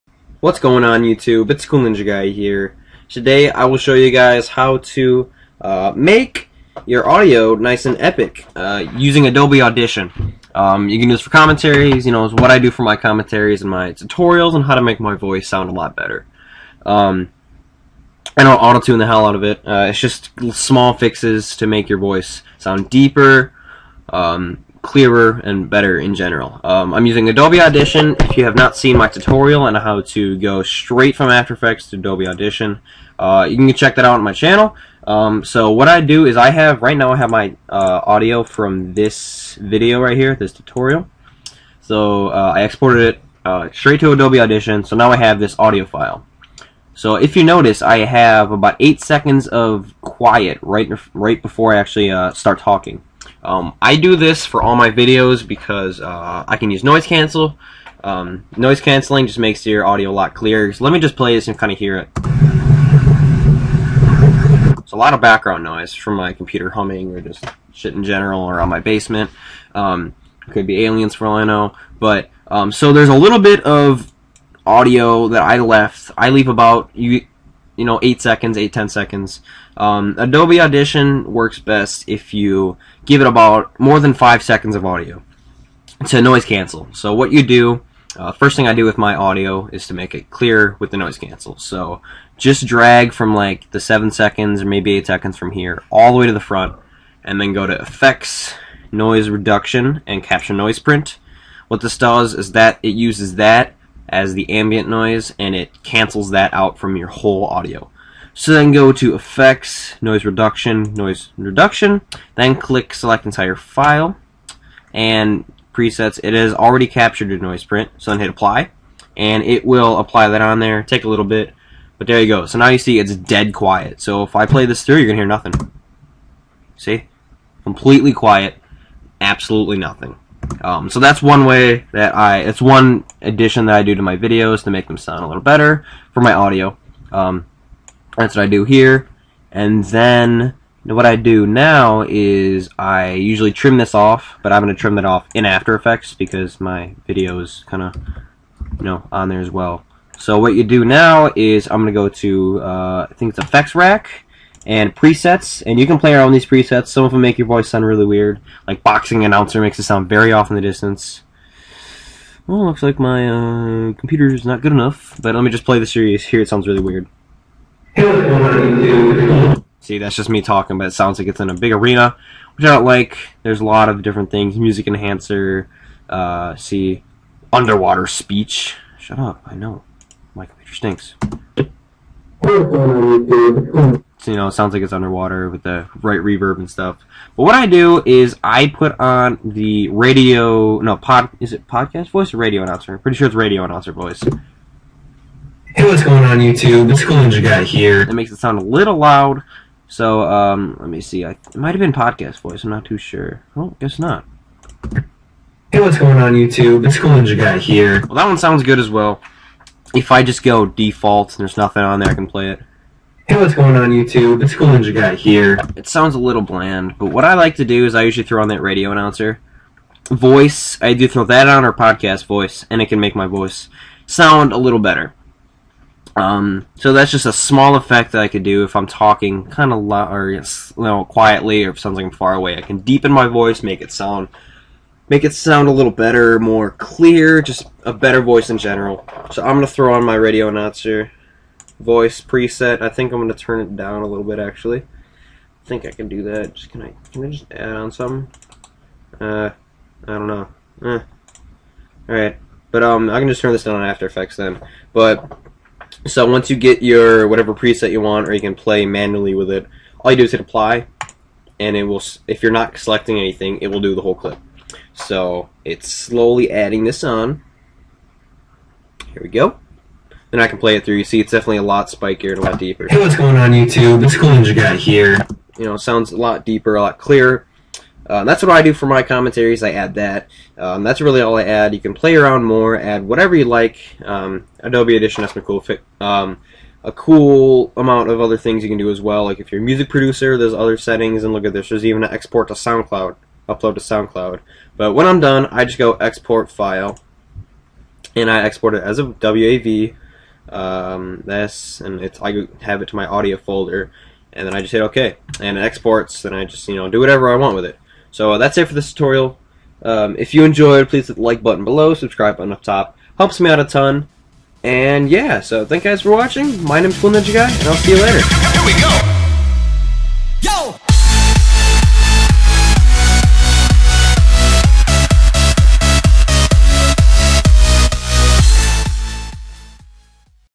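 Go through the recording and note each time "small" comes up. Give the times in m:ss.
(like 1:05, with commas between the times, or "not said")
0:20, 3:47.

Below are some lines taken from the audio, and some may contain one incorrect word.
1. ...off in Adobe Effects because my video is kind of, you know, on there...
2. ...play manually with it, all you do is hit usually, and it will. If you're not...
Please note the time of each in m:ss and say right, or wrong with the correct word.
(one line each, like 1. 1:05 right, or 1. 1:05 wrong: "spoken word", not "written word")
1. 2:25 wrong: "After", not "Adobe"
2. 4:18 wrong: "apply", not "usually".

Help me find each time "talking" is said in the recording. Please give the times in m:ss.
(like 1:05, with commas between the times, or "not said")
0:52, 2:50, 3:48.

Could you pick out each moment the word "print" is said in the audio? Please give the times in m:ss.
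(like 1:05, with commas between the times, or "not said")
1:40, 1:57.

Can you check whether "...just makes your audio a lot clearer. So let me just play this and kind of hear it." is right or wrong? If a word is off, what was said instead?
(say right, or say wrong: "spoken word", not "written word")
right.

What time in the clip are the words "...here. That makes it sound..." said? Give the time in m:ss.
3:17.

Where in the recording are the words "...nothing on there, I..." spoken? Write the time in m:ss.
3:31.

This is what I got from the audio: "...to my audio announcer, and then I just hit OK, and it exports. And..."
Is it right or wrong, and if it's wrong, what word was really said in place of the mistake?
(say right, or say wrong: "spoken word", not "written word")
wrong: "folder", not "announcer".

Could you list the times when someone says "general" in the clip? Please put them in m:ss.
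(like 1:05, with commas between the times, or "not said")
0:26, 1:08, 3:58.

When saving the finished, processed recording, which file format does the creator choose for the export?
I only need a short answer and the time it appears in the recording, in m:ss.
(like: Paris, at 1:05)
WAV, at 4:59.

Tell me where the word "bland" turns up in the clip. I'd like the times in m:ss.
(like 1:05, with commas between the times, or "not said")
3:36.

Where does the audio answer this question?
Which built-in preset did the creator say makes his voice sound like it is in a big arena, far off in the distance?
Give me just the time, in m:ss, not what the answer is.
2:38.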